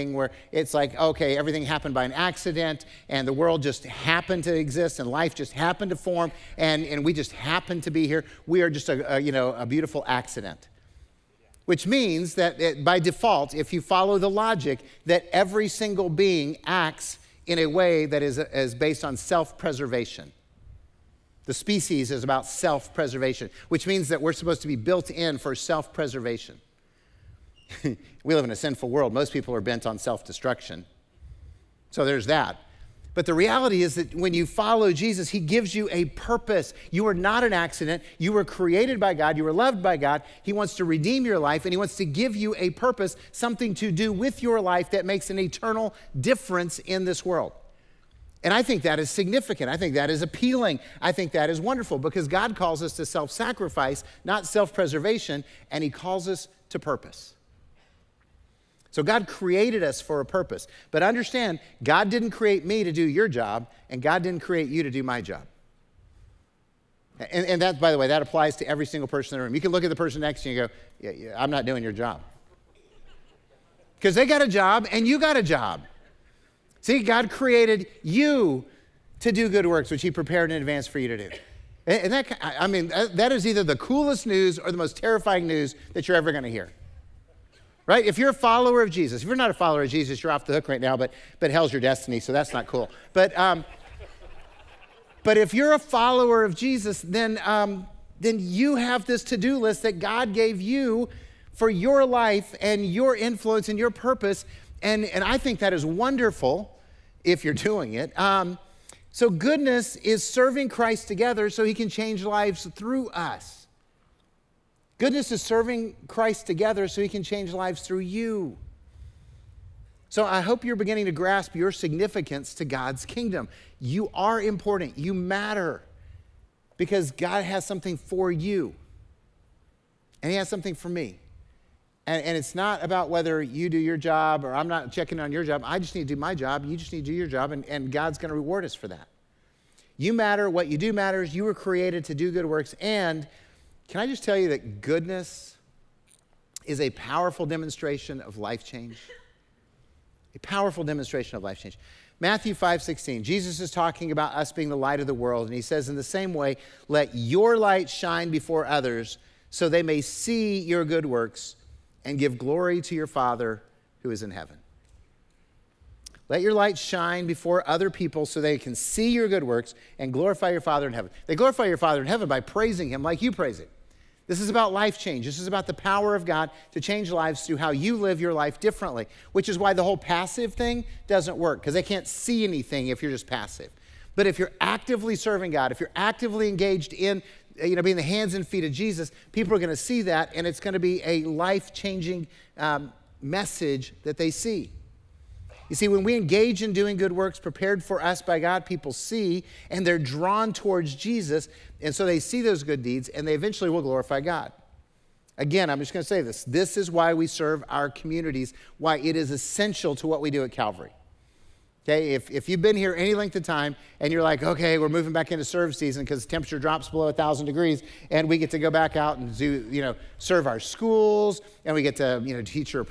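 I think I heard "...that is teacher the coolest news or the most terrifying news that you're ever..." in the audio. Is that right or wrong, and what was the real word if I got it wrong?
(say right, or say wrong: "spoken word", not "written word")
wrong: "either", not "teacher".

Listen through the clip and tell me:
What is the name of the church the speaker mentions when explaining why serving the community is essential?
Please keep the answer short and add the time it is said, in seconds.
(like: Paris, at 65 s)
Calvary, at 210 s.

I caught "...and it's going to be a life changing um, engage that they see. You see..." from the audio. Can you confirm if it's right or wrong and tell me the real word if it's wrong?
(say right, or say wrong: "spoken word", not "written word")
wrong: "message", not "engage".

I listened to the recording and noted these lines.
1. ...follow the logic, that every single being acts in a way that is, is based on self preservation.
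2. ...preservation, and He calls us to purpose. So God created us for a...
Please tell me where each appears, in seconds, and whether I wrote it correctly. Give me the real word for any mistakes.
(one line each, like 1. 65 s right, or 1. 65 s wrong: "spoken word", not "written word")
1. 13 s right
2. 54 s right.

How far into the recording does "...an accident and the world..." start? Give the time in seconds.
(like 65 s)
2 s.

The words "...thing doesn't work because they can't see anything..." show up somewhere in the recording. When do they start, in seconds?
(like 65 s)
180 s.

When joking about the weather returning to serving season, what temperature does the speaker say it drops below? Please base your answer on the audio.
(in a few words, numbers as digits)
1,000 degrees.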